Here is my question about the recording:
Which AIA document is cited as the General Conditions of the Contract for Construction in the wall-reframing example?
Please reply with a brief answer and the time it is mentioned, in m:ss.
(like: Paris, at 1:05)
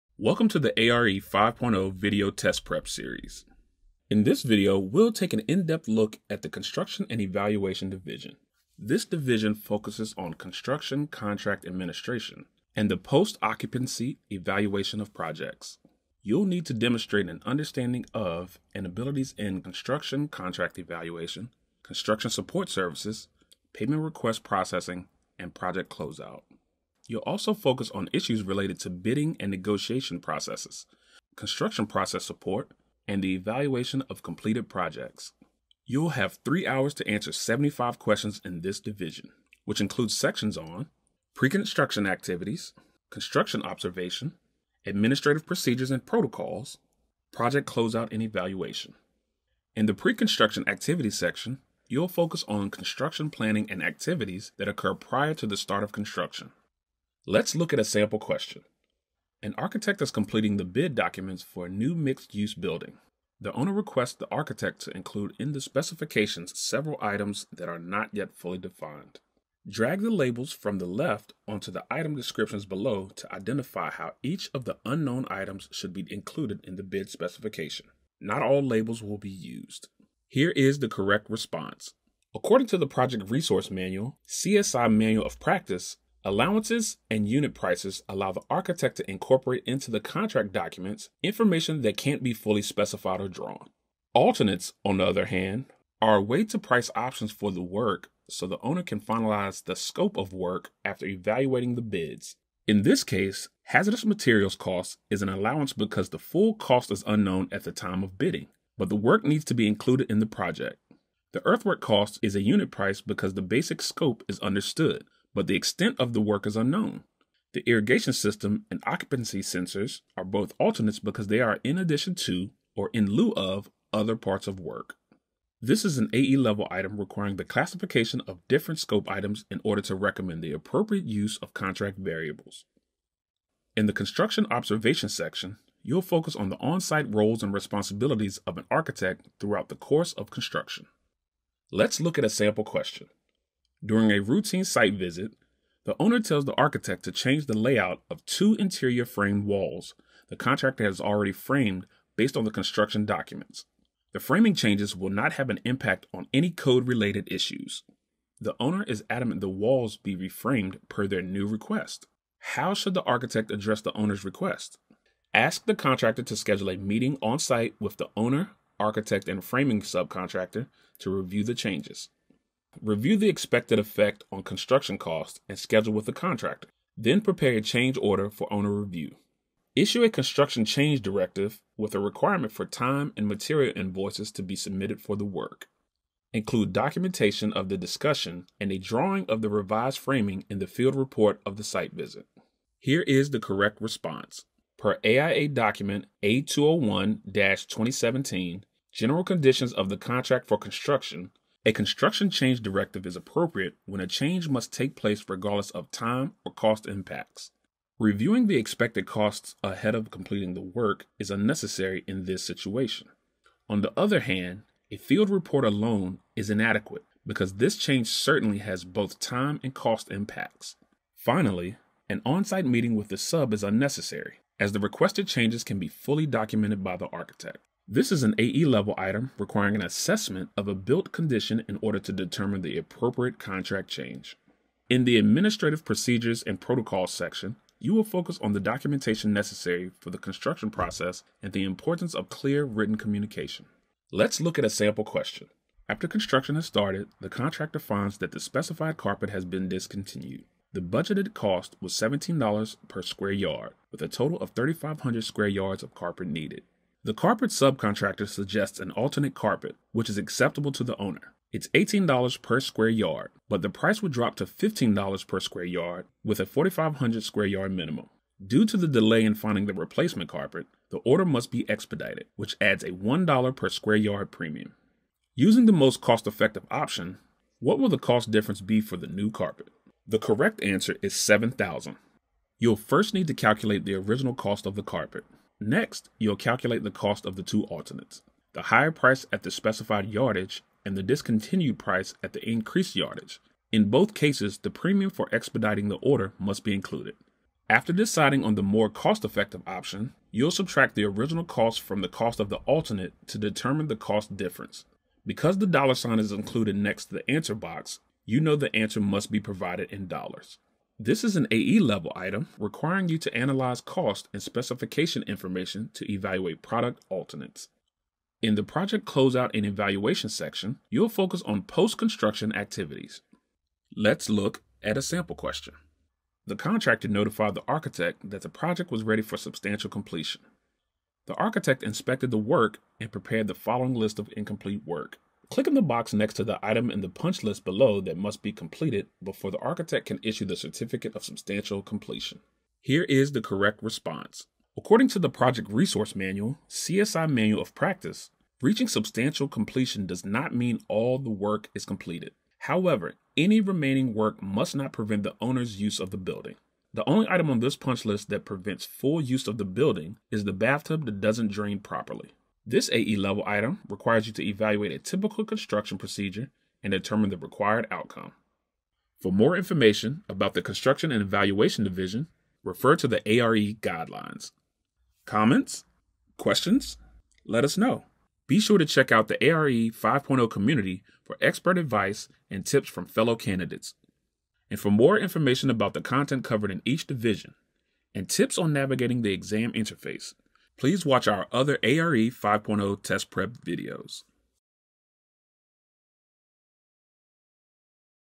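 A201 2017, at 3:16.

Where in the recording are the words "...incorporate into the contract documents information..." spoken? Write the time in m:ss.
1:29.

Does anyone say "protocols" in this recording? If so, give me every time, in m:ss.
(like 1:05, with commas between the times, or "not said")
0:46, 3:56.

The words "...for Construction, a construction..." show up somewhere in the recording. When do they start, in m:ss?
3:20.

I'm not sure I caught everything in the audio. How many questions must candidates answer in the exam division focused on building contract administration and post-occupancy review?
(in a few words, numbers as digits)
75.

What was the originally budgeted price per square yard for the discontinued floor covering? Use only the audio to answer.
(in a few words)
$17.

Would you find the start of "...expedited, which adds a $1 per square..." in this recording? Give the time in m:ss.
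4:31.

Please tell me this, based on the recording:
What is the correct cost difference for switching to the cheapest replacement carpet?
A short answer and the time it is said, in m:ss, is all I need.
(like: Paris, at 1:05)
$7,000, at 4:41.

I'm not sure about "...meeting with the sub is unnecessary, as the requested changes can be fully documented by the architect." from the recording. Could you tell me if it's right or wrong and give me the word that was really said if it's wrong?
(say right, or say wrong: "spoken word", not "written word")
right.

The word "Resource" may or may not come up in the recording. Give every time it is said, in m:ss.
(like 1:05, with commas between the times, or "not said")
1:23, 5:45.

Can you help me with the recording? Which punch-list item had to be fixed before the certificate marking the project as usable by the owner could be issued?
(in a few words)
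Bathtub that doesn't drain.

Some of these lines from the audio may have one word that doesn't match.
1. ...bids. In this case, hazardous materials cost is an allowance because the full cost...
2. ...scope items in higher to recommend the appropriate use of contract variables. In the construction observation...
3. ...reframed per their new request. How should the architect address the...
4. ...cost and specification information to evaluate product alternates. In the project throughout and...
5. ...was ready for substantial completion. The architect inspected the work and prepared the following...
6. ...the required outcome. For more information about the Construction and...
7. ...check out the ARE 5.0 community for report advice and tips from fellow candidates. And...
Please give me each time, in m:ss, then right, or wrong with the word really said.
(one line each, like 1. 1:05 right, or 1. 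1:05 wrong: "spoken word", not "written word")
1. 1:41 right
2. 2:08 wrong: "order", not "higher"
3. 2:40 right
4. 5:13 wrong: "closeout", not "throughout"
5. 5:28 right
6. 6:07 right
7. 6:18 wrong: "expert", not "report".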